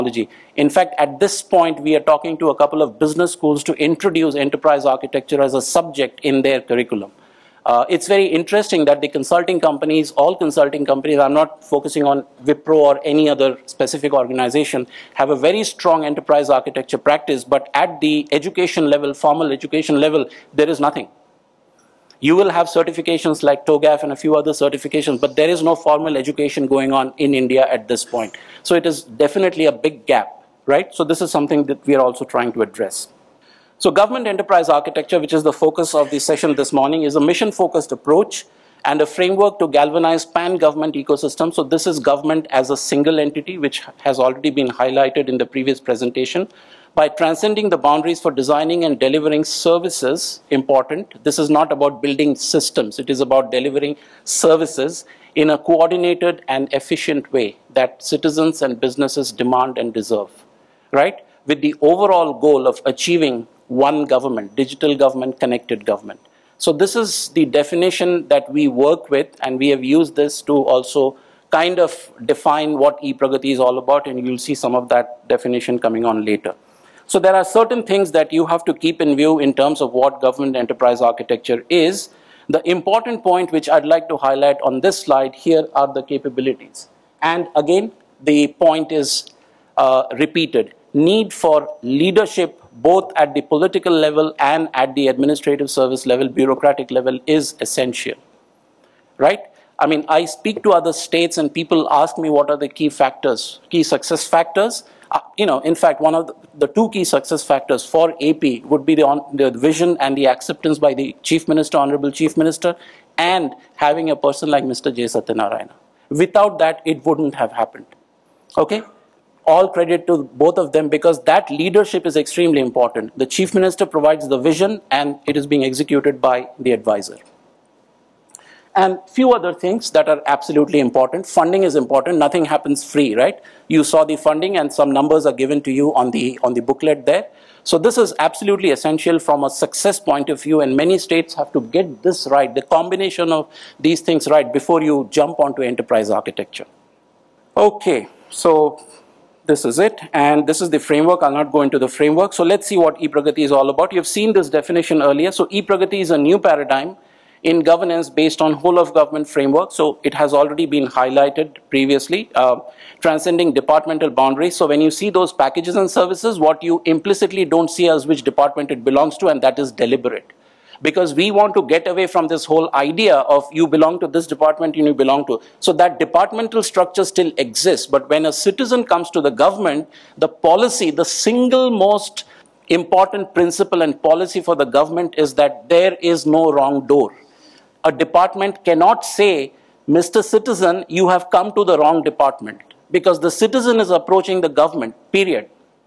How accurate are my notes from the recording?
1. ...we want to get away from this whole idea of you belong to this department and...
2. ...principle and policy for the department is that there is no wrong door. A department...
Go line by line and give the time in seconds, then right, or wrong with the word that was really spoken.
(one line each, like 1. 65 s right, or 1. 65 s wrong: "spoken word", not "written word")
1. 171 s right
2. 183 s wrong: "government", not "department".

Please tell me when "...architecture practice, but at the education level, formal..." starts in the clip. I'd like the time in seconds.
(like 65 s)
16 s.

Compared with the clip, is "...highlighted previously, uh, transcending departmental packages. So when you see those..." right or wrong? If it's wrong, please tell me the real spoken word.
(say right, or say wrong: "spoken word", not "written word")
wrong: "boundaries", not "packages".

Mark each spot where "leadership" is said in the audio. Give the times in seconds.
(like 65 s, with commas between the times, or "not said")
91 s, 121 s.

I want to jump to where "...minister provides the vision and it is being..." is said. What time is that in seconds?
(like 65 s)
123 s.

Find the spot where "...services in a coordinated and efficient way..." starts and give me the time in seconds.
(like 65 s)
54 s.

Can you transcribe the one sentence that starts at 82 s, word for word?
The important point which I'd like to highlight on this slide here are the capabilities.